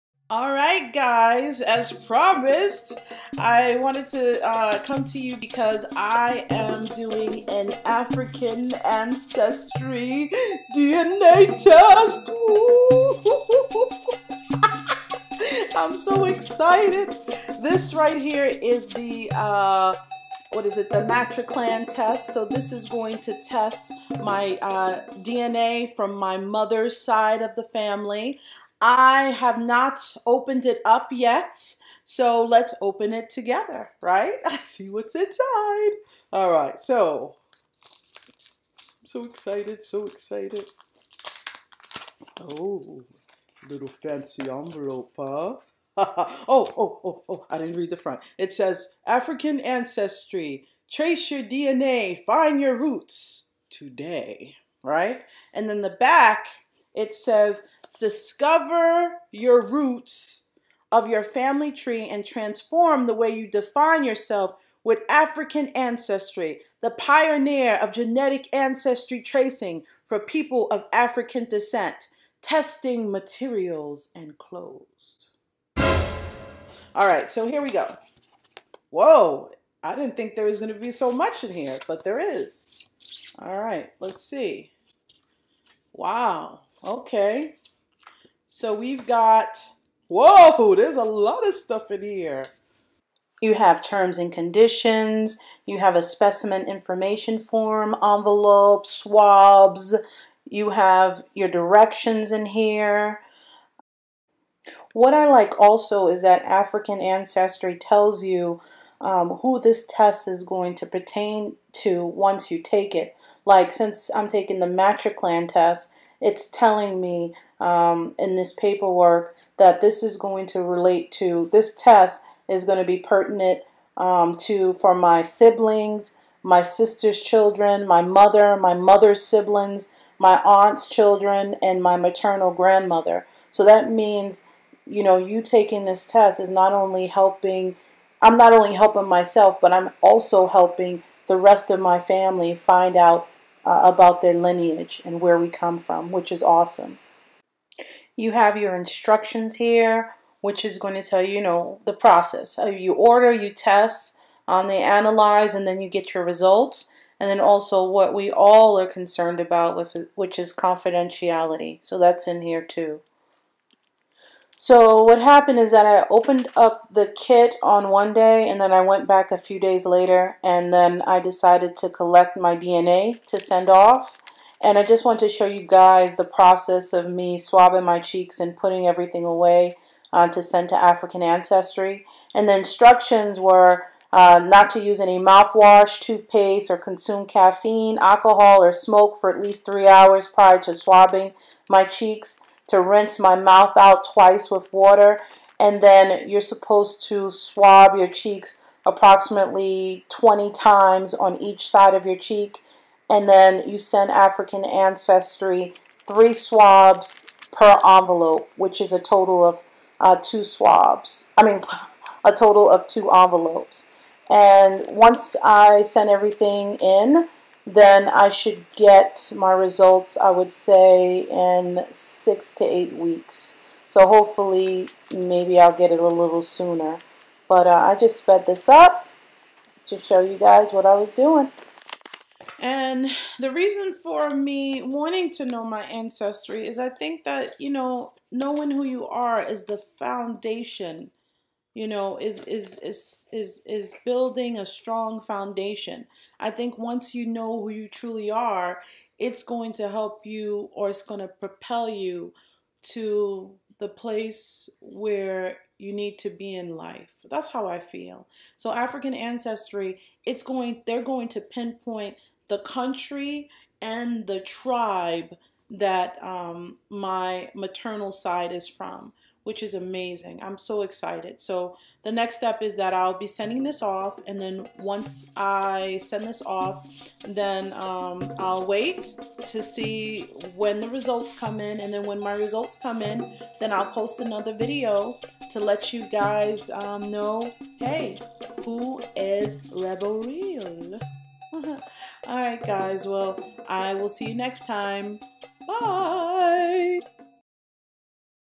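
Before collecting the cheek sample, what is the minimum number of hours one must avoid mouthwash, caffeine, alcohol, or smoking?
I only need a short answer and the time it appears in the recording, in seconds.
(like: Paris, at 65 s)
3, at 189 s.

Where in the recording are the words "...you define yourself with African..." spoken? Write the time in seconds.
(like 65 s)
63 s.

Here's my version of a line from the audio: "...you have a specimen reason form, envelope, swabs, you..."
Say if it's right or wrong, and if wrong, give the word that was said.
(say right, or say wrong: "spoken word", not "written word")
wrong: "information", not "reason".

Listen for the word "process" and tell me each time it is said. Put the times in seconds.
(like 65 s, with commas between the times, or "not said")
151 s, 176 s.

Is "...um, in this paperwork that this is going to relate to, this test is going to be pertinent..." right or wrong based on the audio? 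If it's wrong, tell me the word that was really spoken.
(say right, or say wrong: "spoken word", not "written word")
right.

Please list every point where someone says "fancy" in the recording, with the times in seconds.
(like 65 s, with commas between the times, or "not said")
43 s.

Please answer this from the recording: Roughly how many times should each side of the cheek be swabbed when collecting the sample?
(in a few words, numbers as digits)
20.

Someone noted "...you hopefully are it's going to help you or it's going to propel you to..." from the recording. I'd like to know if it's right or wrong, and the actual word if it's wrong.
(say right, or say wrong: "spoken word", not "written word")
wrong: "truly", not "hopefully".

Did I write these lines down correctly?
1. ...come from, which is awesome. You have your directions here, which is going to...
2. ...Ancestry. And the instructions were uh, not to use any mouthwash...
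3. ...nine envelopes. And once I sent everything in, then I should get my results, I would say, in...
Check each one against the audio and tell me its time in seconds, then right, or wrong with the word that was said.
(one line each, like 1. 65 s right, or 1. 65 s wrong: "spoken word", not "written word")
1. 145 s wrong: "instructions", not "directions"
2. 181 s right
3. 212 s wrong: "two", not "nine".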